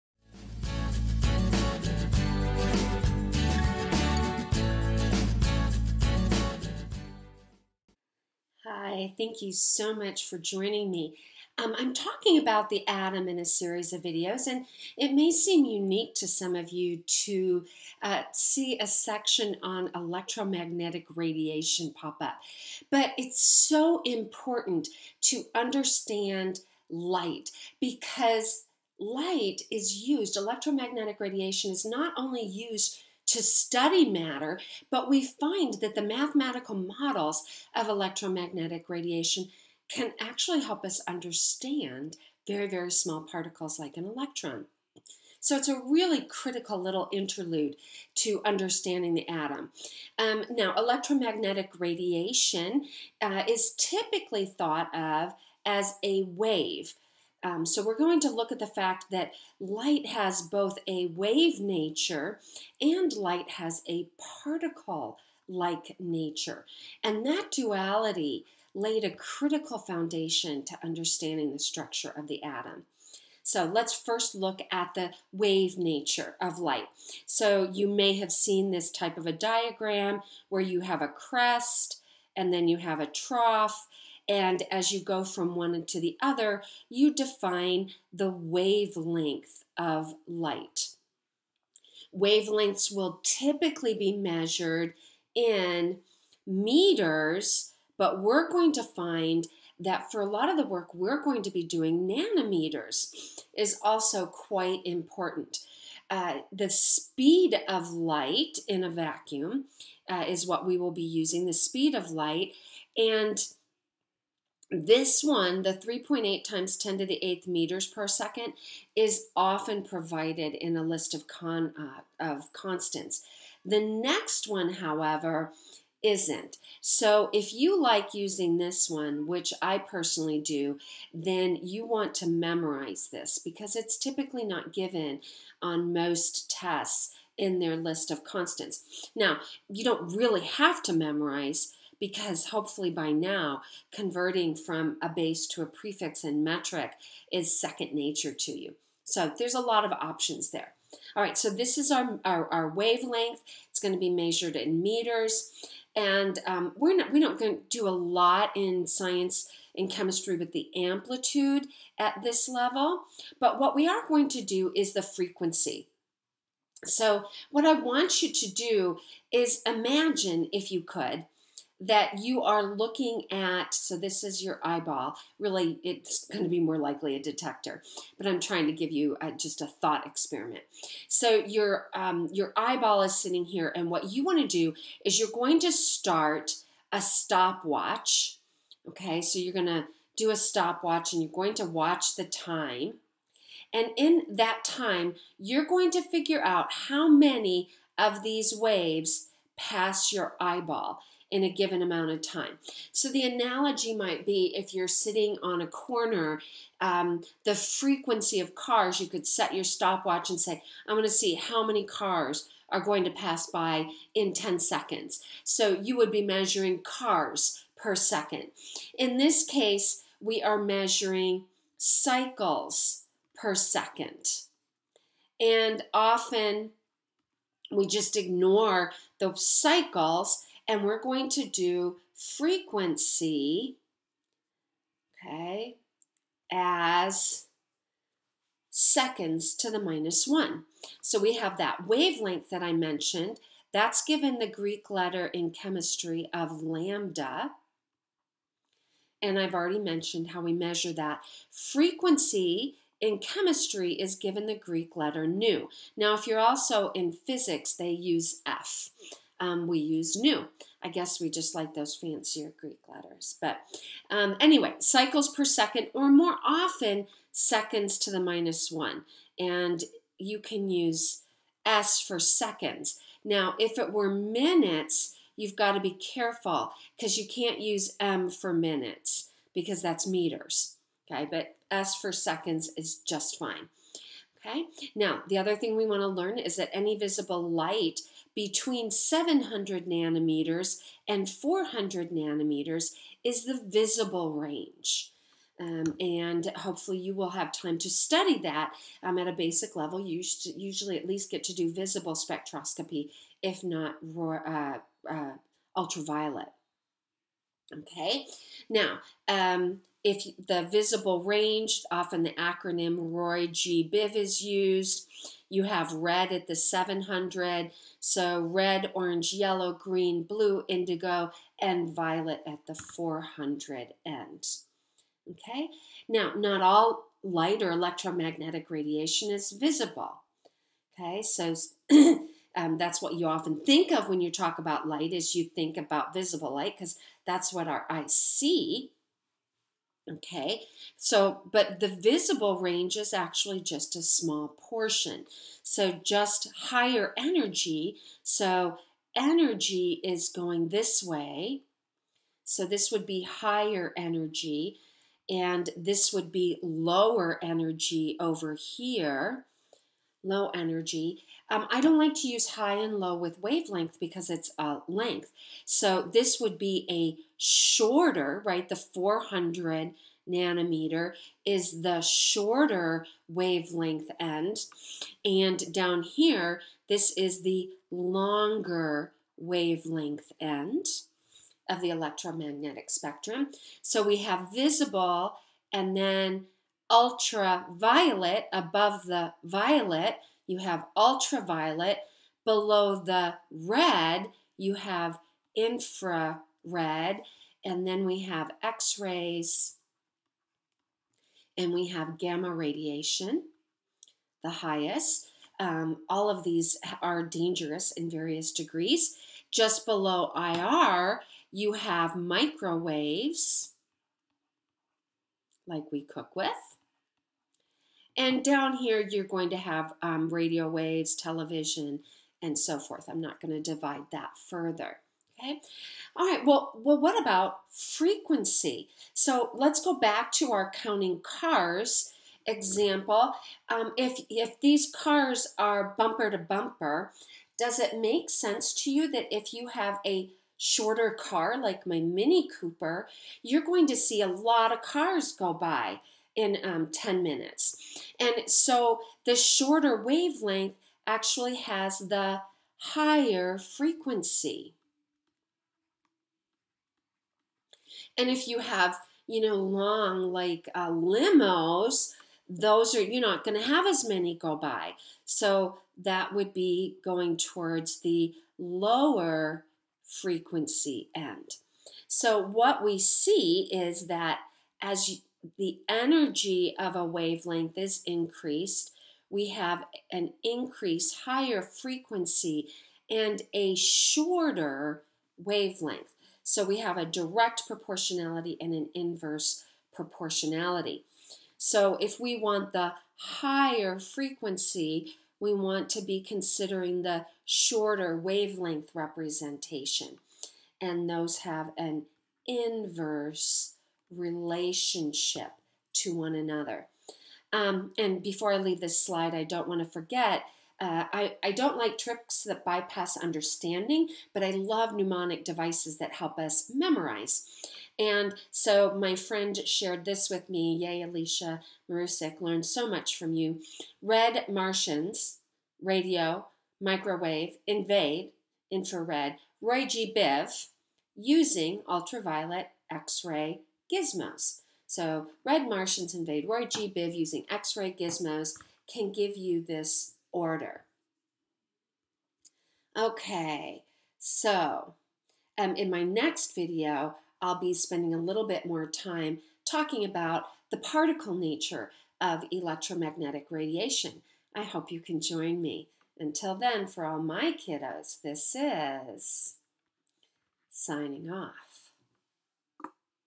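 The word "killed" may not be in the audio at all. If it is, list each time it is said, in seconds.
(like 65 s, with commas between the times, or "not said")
not said.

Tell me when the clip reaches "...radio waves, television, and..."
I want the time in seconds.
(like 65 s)
420 s.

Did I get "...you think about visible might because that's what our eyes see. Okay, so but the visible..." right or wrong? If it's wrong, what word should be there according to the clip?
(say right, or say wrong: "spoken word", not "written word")
wrong: "light", not "might".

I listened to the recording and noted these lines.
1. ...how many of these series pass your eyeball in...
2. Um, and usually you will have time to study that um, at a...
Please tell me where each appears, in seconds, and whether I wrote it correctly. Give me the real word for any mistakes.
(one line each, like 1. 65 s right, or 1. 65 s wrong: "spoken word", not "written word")
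1. 196 s wrong: "waves", not "series"
2. 295 s wrong: "hopefully", not "usually".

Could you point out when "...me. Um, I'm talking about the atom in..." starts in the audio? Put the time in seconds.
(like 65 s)
10 s.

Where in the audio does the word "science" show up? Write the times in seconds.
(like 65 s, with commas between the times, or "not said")
158 s.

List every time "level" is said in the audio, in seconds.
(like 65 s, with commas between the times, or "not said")
162 s, 299 s.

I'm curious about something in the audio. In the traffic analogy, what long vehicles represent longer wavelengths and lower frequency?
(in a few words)
limos.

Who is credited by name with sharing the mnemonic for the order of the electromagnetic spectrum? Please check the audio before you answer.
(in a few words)
Alicia Marusik.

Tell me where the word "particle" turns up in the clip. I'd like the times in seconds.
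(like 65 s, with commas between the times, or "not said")
43 s, 64 s, 550 s.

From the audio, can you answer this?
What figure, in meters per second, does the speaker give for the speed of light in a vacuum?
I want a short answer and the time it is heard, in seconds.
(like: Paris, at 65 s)
3.8 × 10^8, at 115 s.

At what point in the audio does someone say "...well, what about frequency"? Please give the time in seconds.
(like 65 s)
426 s.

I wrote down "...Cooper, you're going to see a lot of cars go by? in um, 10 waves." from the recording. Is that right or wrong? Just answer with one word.
wrong.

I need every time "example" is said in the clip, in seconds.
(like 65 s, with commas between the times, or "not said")
432 s.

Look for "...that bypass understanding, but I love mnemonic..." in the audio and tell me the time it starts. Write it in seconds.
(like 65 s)
512 s.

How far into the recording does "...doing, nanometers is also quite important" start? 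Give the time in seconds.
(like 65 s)
101 s.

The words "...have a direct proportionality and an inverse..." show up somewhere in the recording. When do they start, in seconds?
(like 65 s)
486 s.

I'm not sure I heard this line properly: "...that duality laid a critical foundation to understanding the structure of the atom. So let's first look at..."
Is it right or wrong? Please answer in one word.
right.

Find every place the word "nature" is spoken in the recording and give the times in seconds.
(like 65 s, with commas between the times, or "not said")
61 s, 65 s, 75 s, 147 s, 551 s.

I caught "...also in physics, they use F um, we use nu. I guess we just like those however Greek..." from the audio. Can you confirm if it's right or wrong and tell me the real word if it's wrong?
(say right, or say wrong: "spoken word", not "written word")
wrong: "fancier", not "however".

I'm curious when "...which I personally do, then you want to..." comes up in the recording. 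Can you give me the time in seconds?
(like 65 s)
129 s.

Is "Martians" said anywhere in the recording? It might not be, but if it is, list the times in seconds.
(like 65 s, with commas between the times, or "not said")
524 s, 535 s.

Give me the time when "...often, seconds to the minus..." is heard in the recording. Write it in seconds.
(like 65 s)
266 s.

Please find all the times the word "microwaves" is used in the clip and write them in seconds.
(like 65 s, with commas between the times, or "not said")
412 s, 526 s.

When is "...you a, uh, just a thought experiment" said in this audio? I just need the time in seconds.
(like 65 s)
178 s.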